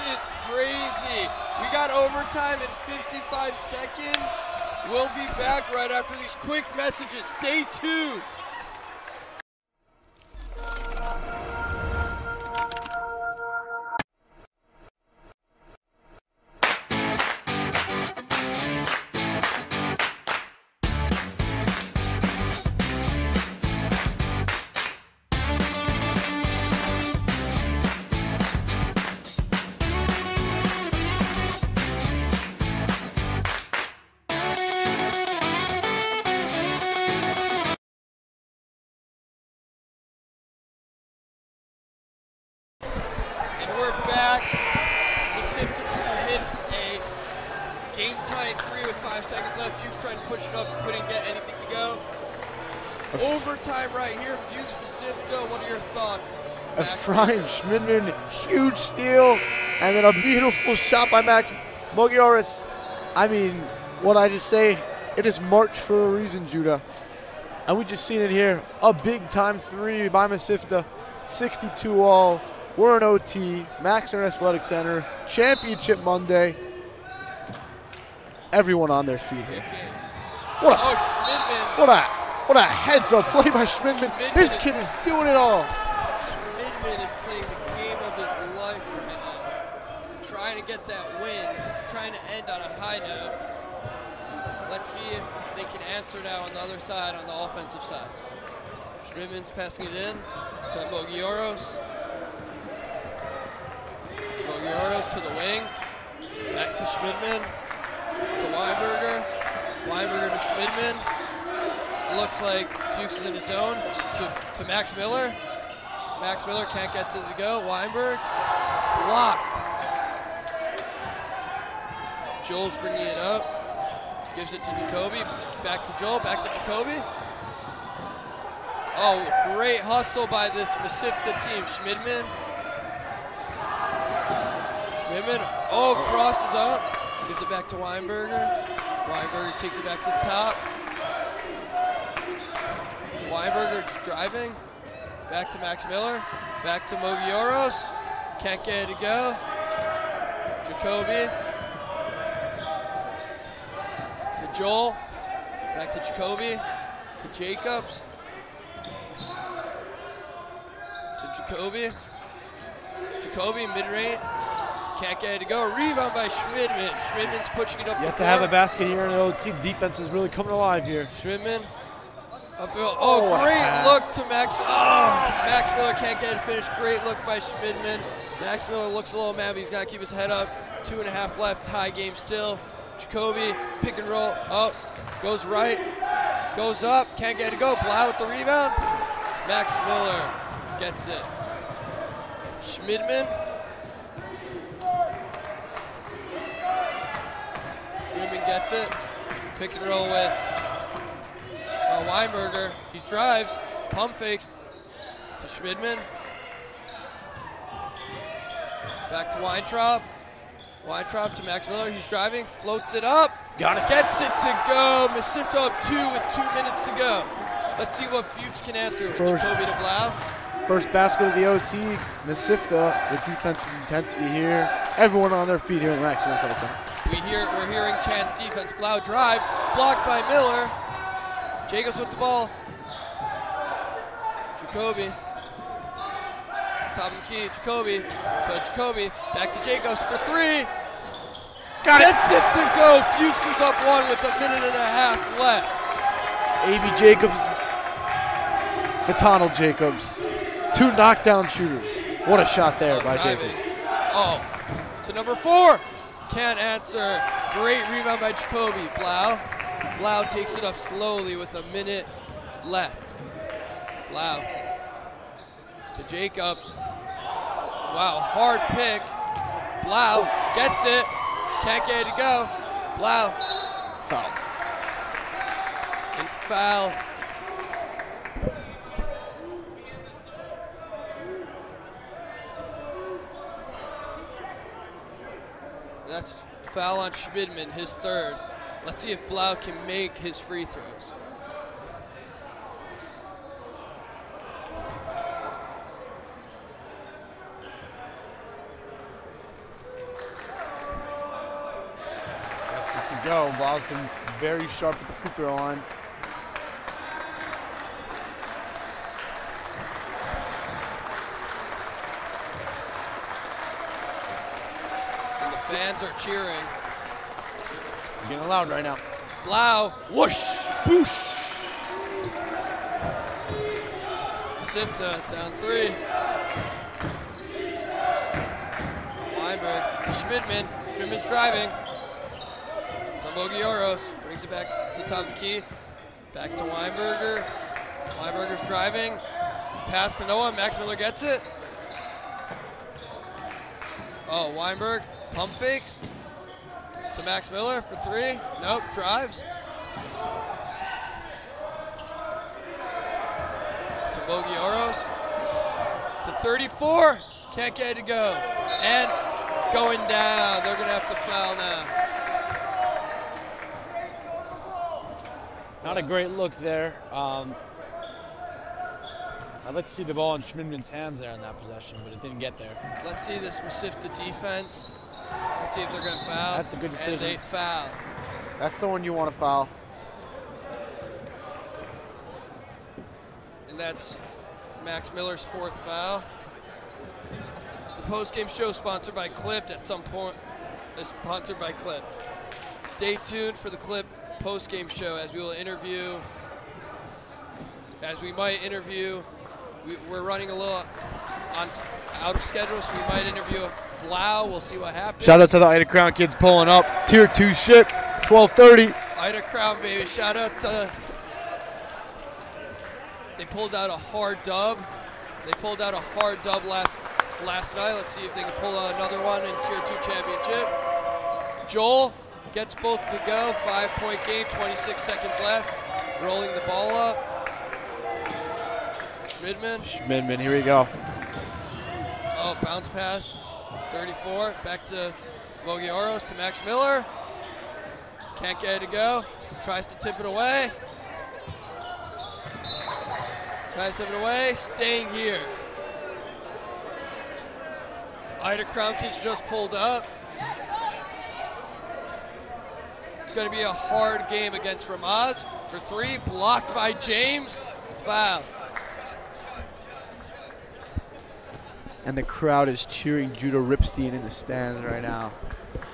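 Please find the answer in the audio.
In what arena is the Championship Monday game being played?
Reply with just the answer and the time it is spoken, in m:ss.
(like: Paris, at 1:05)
Max Stern Athletic Center, at 1:13.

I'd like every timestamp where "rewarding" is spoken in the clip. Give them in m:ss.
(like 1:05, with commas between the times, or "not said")
not said.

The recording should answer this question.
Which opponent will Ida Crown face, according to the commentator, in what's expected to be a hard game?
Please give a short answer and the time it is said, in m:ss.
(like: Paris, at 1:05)
Ramaz, at 7:34.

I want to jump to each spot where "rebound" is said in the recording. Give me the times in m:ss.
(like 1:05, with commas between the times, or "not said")
2:45, 3:08, 4:17.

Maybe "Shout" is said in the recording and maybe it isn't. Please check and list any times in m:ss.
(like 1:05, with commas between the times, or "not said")
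6:45, 6:50.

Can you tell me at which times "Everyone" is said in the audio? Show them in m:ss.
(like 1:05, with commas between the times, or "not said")
1:18, 3:44.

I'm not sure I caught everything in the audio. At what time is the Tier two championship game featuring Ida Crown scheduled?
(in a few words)
12:30.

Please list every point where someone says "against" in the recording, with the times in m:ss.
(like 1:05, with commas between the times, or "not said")
7:34.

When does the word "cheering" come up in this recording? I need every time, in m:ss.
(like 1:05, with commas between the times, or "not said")
5:16, 7:42.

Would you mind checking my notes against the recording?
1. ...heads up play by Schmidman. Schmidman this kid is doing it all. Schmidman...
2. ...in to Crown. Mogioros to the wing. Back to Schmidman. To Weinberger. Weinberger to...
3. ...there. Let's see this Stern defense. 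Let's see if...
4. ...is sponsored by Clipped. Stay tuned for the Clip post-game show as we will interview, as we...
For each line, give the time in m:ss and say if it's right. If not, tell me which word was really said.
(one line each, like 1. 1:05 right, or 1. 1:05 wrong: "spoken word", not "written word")
1. 1:22 right
2. 1:39 wrong: "Mogioros", not "Crown"
3. 6:12 wrong: "Mesivta", not "Stern"
4. 6:30 right.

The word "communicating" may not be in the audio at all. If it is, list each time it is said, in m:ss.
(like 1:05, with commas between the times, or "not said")
not said.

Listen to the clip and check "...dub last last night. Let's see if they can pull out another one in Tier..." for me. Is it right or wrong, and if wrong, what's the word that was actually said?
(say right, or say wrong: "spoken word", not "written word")
right.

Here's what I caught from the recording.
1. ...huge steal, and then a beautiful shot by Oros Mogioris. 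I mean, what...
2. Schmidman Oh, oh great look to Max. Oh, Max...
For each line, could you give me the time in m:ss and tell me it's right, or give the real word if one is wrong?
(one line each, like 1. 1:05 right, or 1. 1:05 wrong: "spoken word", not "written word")
1. 0:58 wrong: "Max", not "Oros"
2. 2:51 right.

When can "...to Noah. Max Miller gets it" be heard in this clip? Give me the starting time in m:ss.
5:40.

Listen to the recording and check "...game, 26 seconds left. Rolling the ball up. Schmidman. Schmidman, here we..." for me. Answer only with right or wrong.
right.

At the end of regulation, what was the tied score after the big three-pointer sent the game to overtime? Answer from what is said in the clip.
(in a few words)
62 all.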